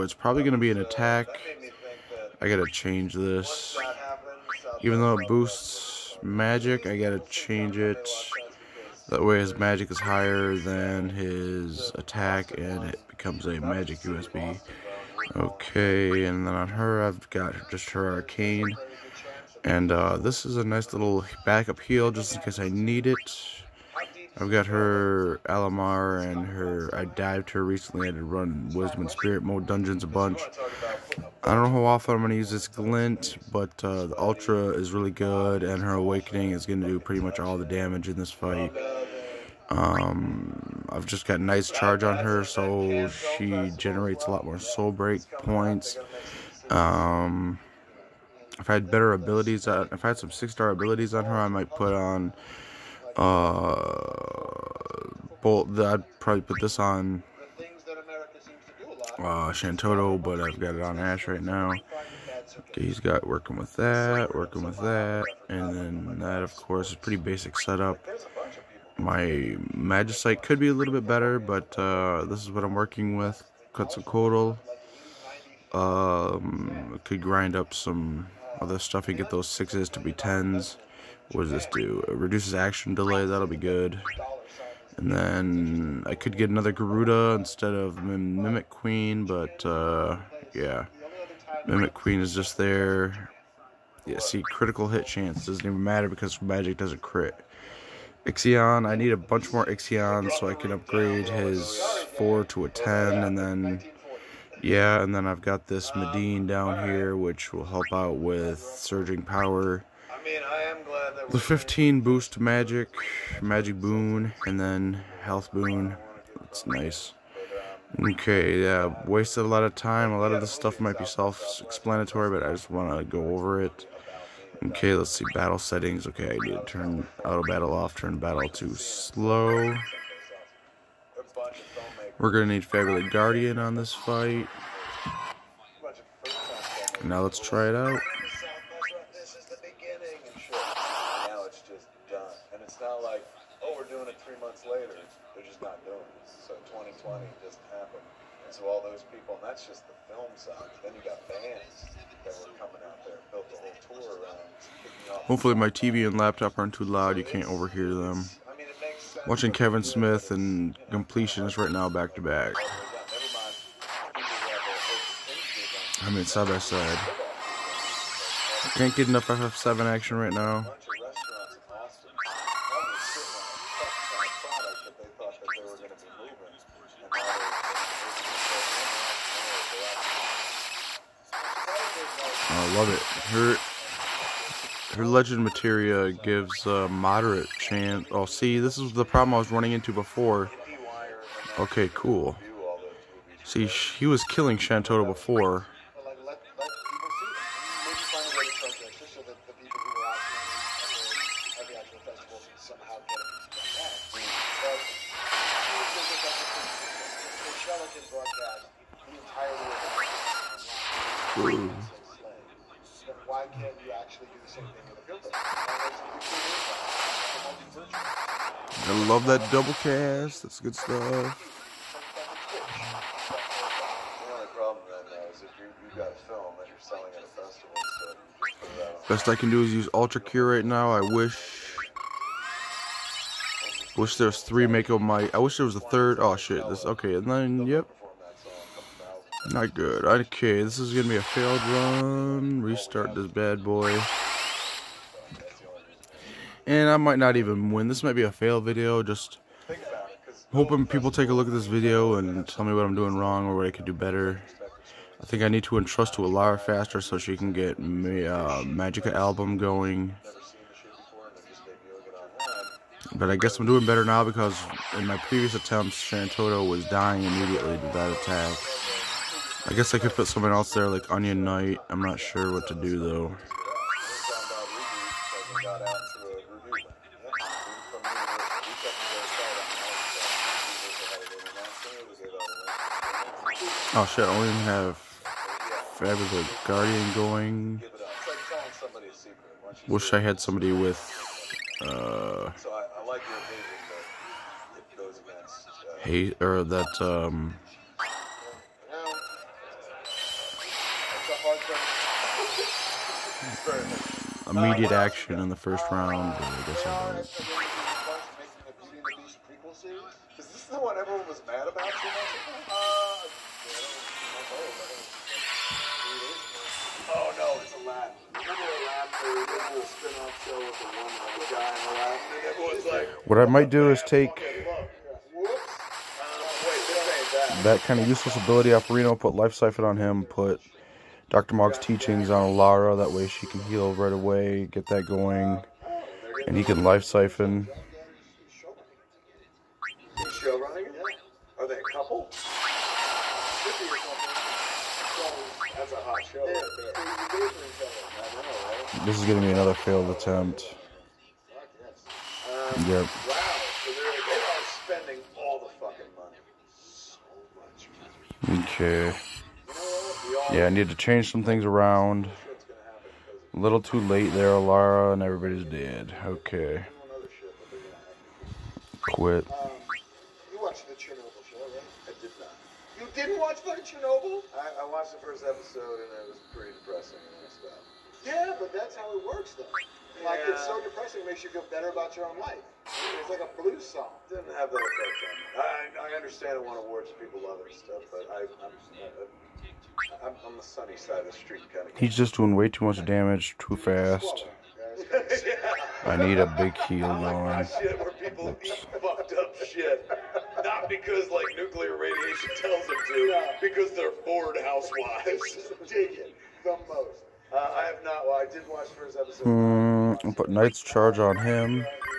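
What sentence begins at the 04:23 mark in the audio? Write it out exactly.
But I guess I'm doing better now because in my previous attempts, Shantotto was dying immediately to that attack.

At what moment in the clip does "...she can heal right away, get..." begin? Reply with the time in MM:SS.
05:33.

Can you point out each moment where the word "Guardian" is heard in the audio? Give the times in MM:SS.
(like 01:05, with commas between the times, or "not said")
02:13, 04:46.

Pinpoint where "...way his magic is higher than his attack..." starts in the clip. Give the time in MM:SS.
00:09.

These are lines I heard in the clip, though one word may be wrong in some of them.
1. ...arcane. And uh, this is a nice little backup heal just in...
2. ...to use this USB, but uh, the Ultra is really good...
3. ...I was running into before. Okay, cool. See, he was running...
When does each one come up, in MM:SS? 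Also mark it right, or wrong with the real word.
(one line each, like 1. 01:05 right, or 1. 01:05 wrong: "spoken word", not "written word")
1. 00:18 right
2. 00:32 wrong: "Glint", not "USB"
3. 03:09 wrong: "killing", not "running".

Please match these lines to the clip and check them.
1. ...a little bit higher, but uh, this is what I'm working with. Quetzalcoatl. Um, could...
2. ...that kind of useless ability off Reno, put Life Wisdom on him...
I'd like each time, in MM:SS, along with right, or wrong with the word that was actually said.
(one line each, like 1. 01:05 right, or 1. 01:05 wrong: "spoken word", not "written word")
1. 01:10 wrong: "better", not "higher"
2. 05:27 wrong: "Siphon", not "Wisdom".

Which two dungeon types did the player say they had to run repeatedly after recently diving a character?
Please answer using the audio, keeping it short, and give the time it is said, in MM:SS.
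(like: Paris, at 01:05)
Wisdom and Spirit, at 00:28.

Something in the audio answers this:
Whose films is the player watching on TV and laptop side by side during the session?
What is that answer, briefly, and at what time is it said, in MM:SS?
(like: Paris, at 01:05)
Kevin Smith, at 02:39.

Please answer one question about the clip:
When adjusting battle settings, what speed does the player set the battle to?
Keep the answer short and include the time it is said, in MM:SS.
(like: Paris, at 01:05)
slow, at 02:08.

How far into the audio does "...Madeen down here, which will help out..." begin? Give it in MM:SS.
01:45.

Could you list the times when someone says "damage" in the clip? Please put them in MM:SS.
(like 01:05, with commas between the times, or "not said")
00:37, 06:33.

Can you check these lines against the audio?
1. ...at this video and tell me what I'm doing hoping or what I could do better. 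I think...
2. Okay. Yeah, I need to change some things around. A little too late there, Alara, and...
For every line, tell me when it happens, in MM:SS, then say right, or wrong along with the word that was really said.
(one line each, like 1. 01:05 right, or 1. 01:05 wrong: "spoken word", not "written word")
1. 04:11 wrong: "wrong", not "hoping"
2. 05:58 right.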